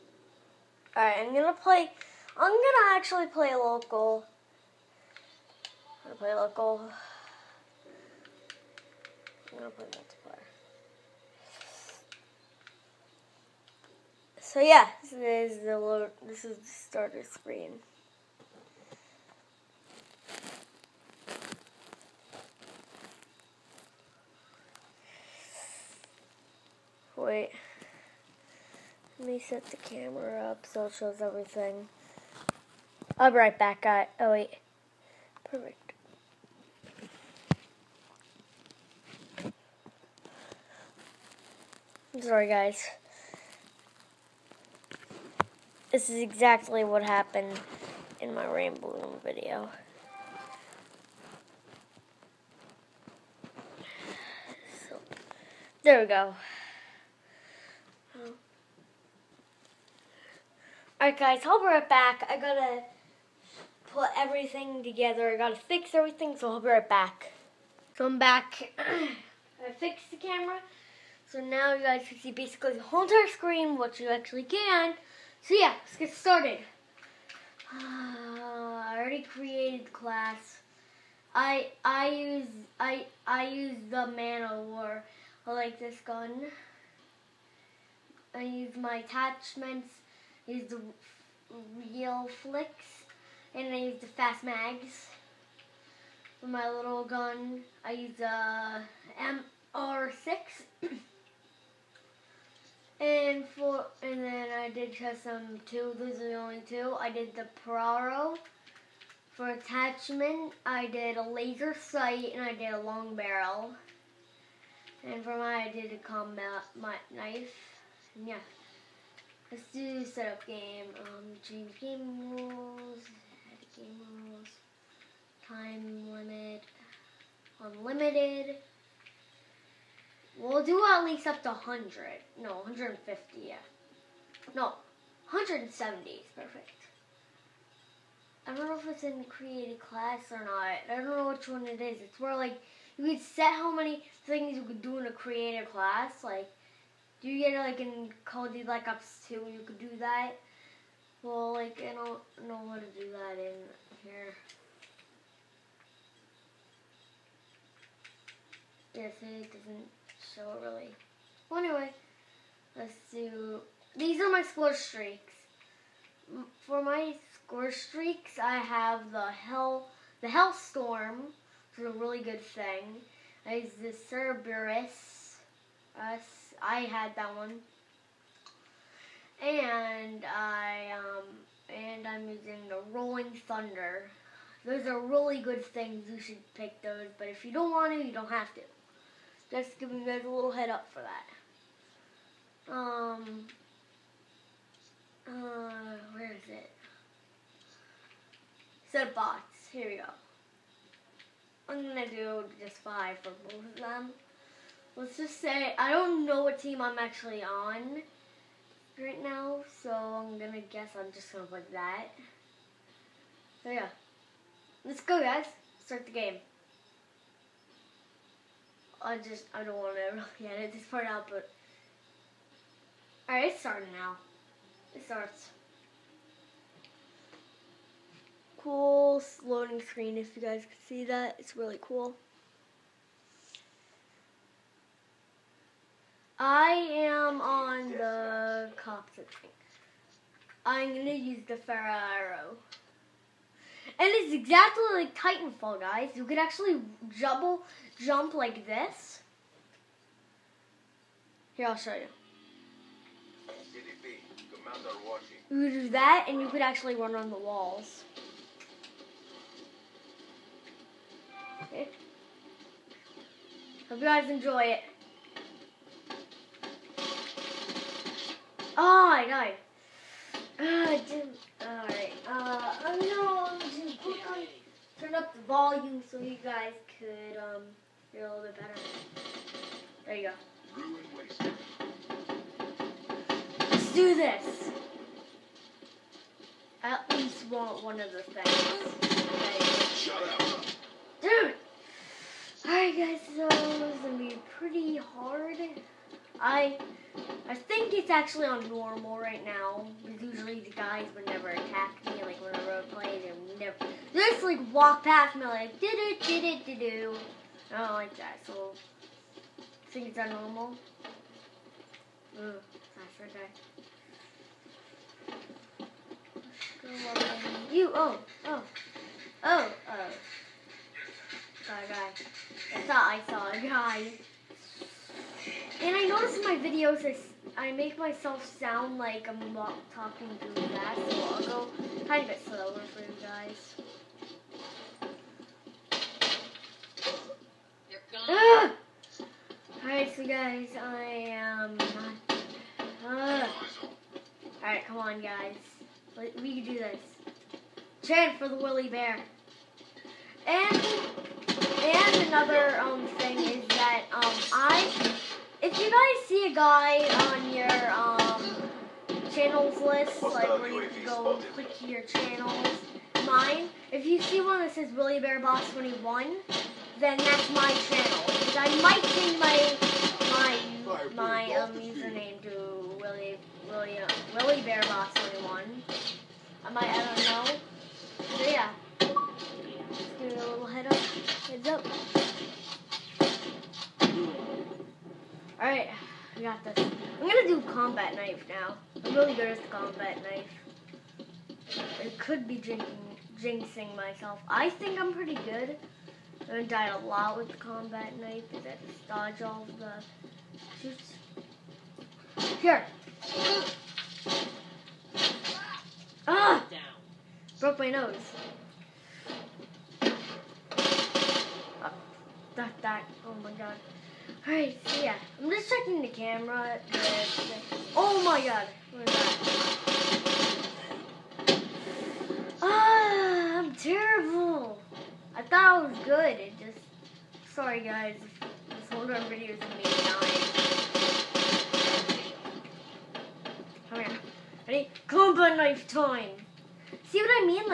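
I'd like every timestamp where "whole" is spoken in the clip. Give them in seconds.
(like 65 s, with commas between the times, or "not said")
72 s, 428 s.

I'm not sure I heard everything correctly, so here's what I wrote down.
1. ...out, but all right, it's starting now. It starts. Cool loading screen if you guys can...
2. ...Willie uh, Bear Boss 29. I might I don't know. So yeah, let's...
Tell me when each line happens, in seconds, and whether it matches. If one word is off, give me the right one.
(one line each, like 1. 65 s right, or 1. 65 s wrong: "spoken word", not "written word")
1. 221 s right
2. 374 s wrong: "21", not "29".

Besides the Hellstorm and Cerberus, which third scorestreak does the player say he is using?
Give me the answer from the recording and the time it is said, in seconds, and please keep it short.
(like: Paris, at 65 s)
Rolling Thunder, at 182 s.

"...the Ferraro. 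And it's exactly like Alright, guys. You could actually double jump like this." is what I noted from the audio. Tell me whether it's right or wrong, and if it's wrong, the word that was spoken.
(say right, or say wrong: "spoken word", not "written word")
wrong: "Titanfall", not "Alright".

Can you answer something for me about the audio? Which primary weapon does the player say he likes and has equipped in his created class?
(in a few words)
Man of War.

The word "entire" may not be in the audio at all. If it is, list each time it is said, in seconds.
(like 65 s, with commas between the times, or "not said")
73 s.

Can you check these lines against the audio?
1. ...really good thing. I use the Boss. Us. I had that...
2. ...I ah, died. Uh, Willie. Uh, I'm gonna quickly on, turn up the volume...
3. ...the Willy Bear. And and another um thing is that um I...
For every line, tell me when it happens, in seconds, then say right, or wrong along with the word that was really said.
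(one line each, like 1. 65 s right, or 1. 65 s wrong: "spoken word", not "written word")
1. 171 s wrong: "Cerberus", not "Boss"
2. 269 s wrong: "Alright", not "Willie"
3. 348 s right.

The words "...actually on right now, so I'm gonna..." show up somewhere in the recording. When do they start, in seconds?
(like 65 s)
206 s.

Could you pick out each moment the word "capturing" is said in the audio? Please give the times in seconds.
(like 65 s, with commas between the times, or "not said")
not said.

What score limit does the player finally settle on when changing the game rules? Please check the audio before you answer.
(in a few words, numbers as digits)
170.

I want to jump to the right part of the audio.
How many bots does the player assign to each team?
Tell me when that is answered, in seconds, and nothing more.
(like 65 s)
202 s.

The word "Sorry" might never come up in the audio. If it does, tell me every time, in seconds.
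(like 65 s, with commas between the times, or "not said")
42 s, 427 s.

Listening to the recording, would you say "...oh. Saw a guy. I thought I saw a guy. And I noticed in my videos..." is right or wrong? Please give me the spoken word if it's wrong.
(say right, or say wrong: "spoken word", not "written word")
right.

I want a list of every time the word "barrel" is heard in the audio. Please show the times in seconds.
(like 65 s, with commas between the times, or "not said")
113 s.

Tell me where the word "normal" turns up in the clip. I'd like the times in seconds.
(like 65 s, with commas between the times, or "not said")
298 s, 310 s.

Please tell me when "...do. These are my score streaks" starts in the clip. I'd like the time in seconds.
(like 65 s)
163 s.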